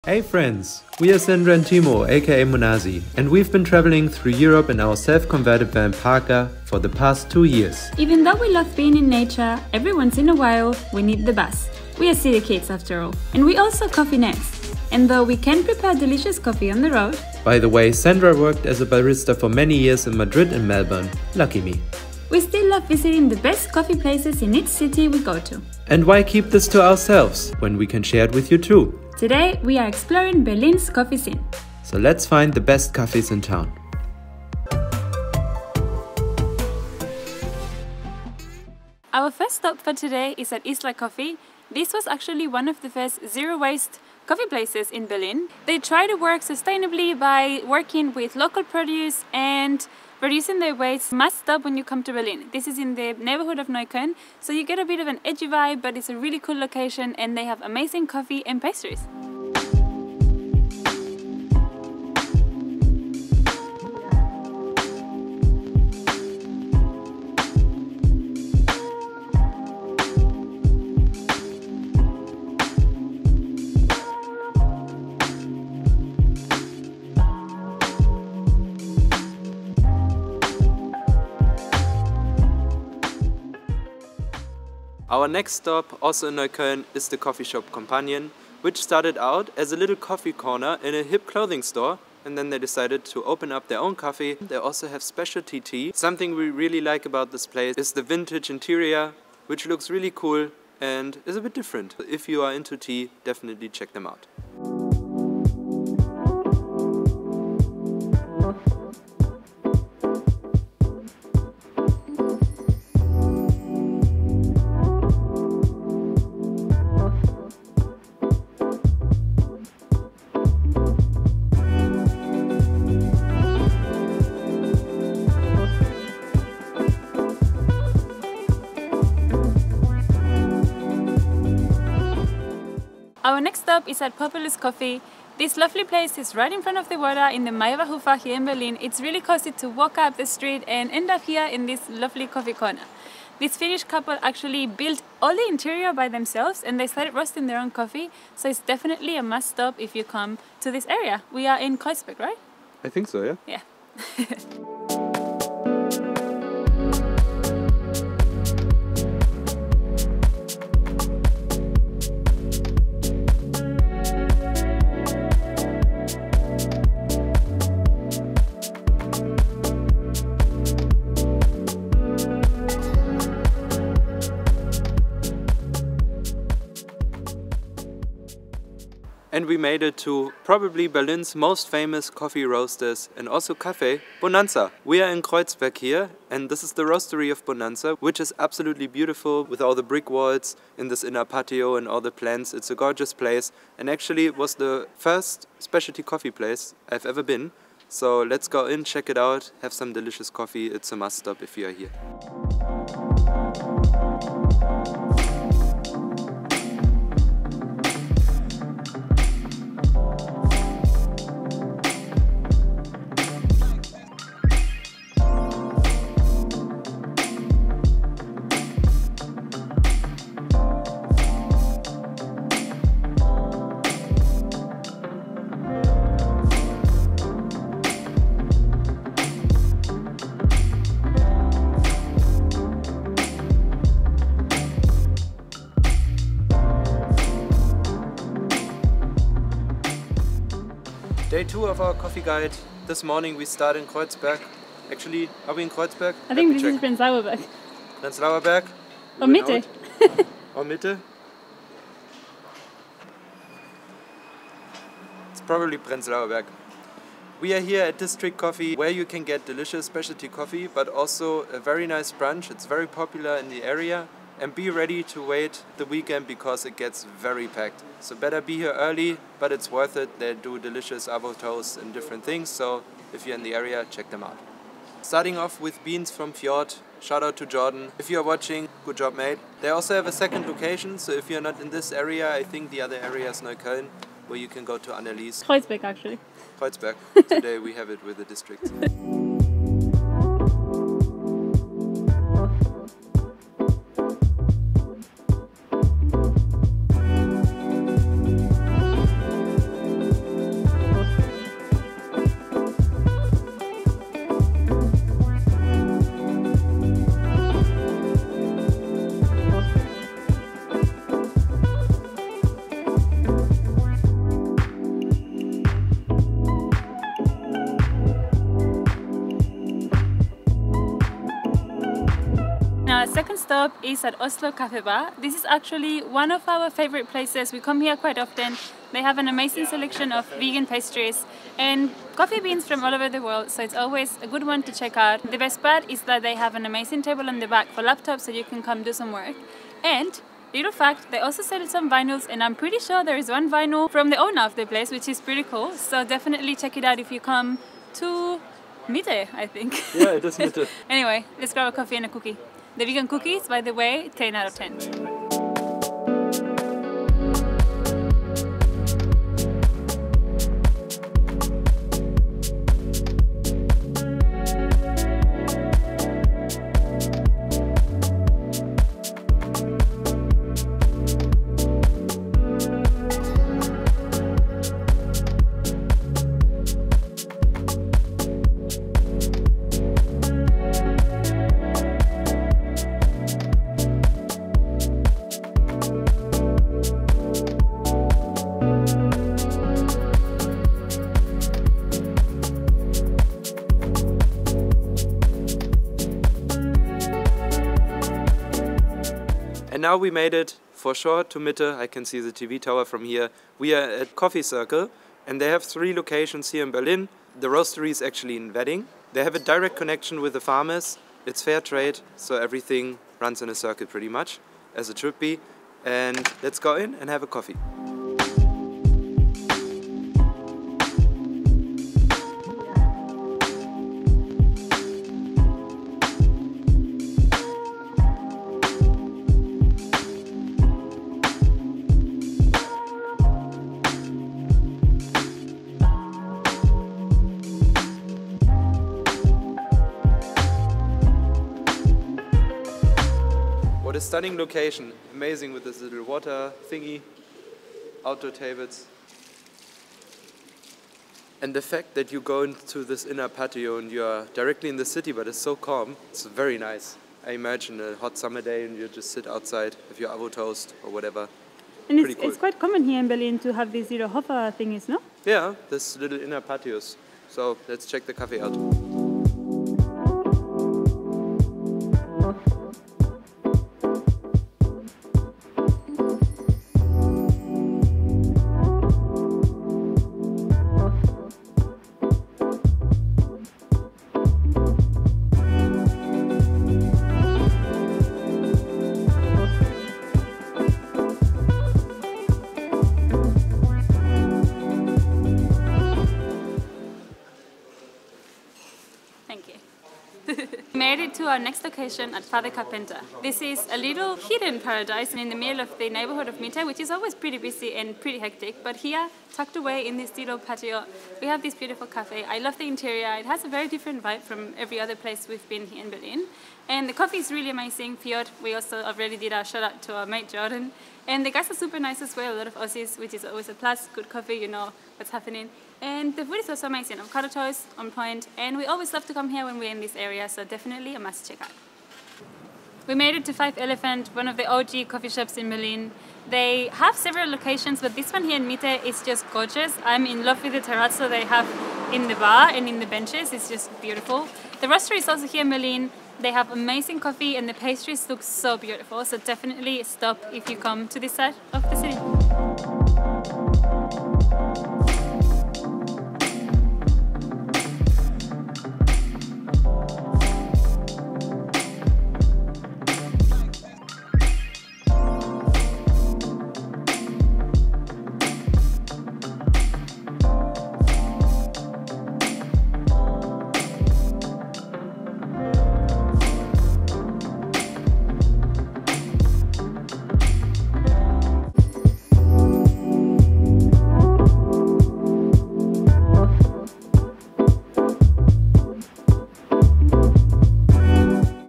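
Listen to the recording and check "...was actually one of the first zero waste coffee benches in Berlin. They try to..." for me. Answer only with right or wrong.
wrong.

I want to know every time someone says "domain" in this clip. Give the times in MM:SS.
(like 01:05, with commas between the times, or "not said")
not said.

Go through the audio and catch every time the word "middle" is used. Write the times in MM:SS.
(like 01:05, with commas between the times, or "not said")
08:25.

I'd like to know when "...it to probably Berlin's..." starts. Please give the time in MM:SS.
02:59.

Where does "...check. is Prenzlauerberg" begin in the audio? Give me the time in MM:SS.
04:06.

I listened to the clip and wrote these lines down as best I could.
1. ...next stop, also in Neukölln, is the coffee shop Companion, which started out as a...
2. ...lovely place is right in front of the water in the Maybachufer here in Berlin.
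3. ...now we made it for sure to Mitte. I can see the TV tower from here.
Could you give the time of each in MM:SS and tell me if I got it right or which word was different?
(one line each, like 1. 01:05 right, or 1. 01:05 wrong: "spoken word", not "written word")
1. 01:25 right
2. 02:15 right
3. 06:39 right.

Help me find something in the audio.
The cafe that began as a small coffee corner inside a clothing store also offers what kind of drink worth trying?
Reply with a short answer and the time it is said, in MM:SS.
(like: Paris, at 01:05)
Specialty tea, at 01:35.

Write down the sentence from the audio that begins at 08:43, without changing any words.
Good coffee, you know what's happening.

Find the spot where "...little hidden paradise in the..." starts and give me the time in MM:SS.
08:23.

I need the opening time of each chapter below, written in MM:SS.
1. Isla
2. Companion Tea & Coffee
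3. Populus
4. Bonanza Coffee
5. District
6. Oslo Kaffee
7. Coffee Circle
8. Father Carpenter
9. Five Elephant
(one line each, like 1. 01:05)
1. 00:59
2. 01:25
3. 02:13
4. 03:00
5. 04:00
6. 05:19
7. 06:37
8. 07:18
9. 08:52.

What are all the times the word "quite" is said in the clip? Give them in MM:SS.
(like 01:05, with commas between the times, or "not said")
05:27, 07:42.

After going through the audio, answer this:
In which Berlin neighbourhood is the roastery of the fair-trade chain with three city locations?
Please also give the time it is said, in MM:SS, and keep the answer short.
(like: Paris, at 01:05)
Wedding, at 06:48.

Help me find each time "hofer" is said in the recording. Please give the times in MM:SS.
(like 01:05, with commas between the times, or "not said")
07:44.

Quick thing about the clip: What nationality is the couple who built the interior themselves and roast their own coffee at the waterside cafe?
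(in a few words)
Finnish.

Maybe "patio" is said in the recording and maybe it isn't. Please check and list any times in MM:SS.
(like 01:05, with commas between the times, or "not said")
03:11, 07:33, 07:46, 08:30.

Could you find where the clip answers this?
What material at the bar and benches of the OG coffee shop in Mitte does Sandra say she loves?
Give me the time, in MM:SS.
09:00.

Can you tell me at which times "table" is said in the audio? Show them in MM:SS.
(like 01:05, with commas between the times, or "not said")
05:37, 07:28.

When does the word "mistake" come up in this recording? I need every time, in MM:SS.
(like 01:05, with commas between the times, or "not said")
not said.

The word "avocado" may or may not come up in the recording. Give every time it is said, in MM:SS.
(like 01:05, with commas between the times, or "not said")
04:31, 07:40, 08:46.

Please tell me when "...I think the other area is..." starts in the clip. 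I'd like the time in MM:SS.
04:42.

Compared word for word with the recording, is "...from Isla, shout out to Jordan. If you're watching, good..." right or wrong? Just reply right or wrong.
wrong.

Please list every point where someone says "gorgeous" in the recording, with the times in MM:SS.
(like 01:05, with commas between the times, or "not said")
03:12, 08:59.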